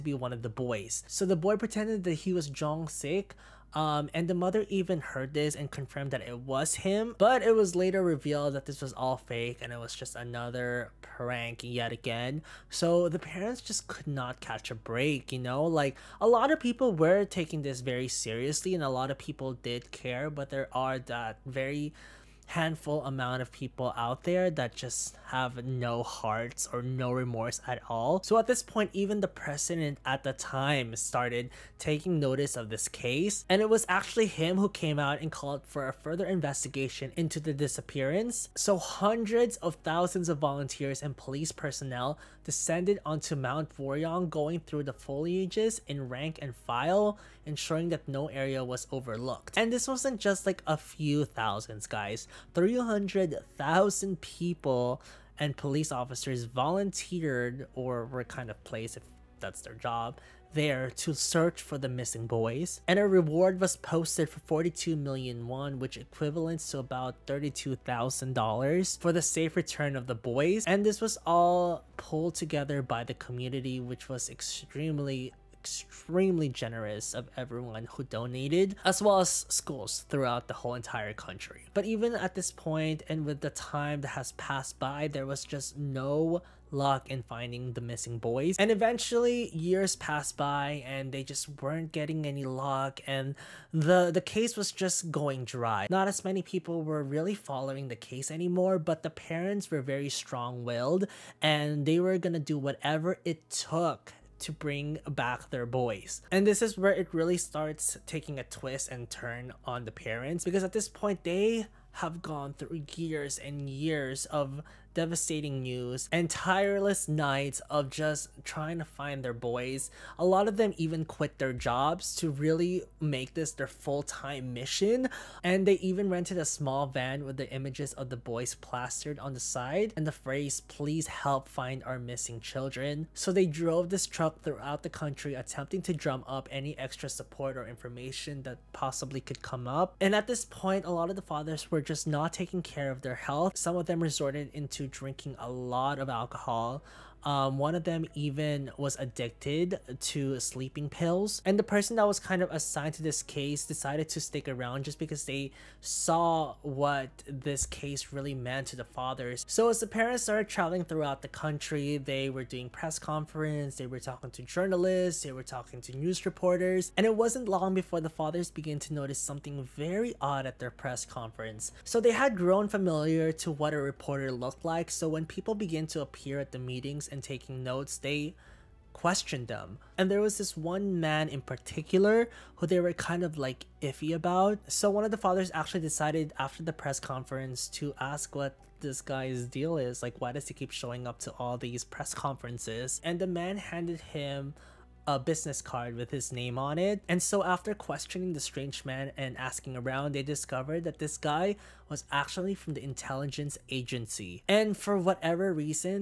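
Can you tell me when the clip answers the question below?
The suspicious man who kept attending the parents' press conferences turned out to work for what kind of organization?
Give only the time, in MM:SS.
03:22.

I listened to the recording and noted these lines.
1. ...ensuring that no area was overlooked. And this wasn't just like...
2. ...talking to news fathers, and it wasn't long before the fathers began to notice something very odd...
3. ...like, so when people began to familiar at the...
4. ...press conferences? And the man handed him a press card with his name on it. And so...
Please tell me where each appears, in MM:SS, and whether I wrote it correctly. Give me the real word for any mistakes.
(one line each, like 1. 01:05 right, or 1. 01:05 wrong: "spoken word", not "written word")
1. 00:47 right
2. 02:45 wrong: "reporters", not "fathers"
3. 02:54 wrong: "appear", not "familiar"
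4. 03:11 wrong: "business", not "press".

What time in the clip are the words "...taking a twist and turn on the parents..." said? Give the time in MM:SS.
01:48.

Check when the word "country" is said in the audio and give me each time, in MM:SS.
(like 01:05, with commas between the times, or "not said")
01:21, 02:14, 02:41.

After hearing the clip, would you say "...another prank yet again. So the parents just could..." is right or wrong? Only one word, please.
right.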